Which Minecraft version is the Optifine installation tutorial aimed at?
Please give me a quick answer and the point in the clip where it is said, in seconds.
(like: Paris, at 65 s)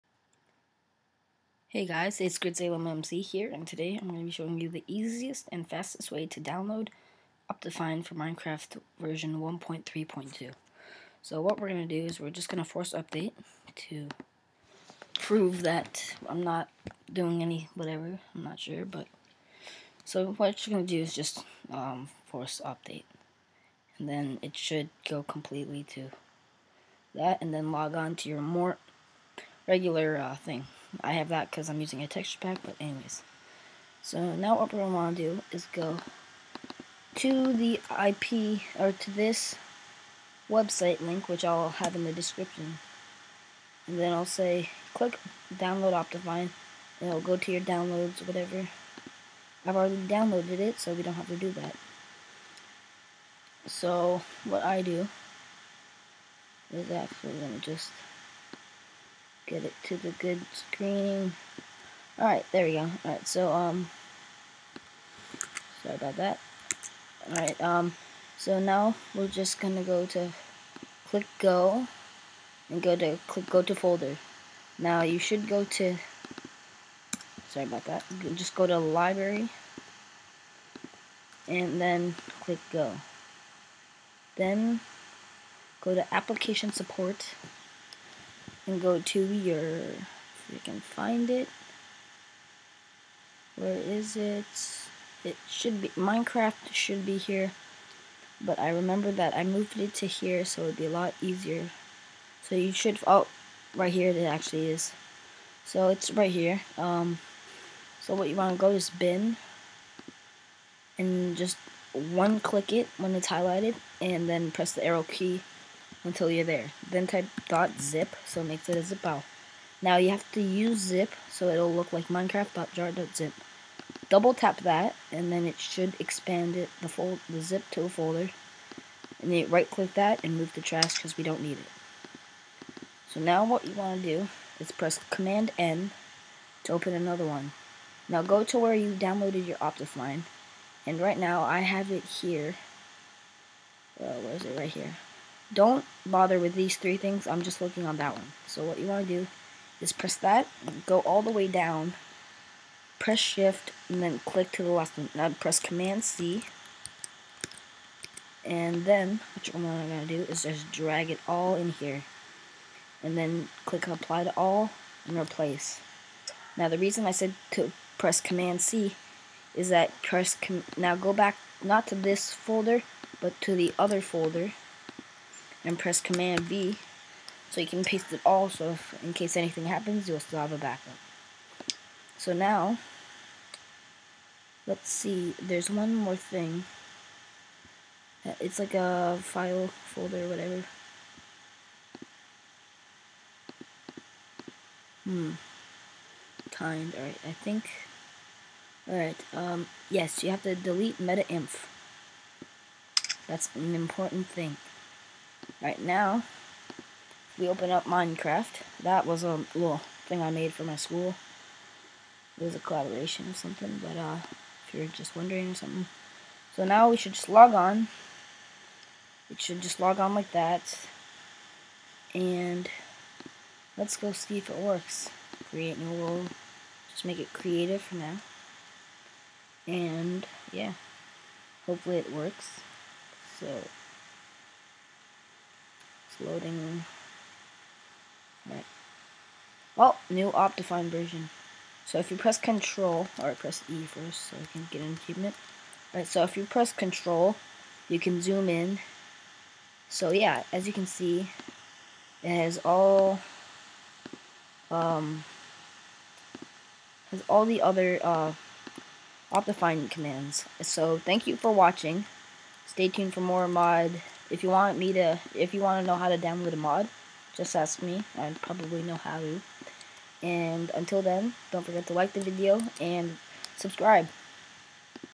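1.3.2, at 9 s.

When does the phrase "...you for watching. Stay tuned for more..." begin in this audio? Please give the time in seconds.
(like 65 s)
261 s.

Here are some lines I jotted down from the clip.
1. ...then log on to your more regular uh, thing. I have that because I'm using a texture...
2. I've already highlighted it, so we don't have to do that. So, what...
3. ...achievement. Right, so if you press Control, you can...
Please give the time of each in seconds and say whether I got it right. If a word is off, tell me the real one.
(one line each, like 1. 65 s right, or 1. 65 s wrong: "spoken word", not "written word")
1. 27 s right
2. 49 s wrong: "downloaded", not "highlighted"
3. 245 s right.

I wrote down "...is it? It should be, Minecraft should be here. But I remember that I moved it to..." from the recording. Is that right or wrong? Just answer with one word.
right.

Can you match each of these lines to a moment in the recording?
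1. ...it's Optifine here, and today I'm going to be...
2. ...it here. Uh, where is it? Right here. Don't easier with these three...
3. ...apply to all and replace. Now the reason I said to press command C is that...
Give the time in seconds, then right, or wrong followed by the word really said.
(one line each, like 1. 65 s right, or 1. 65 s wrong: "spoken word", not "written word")
1. 2 s wrong: "GridSalemMC", not "Optifine"
2. 141 s wrong: "bother", not "easier"
3. 163 s right.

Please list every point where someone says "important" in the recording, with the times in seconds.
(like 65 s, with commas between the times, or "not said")
203 s.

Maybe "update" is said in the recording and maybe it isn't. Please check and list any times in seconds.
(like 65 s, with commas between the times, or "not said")
12 s, 22 s.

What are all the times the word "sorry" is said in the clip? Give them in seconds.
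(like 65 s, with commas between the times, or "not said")
65 s, 77 s.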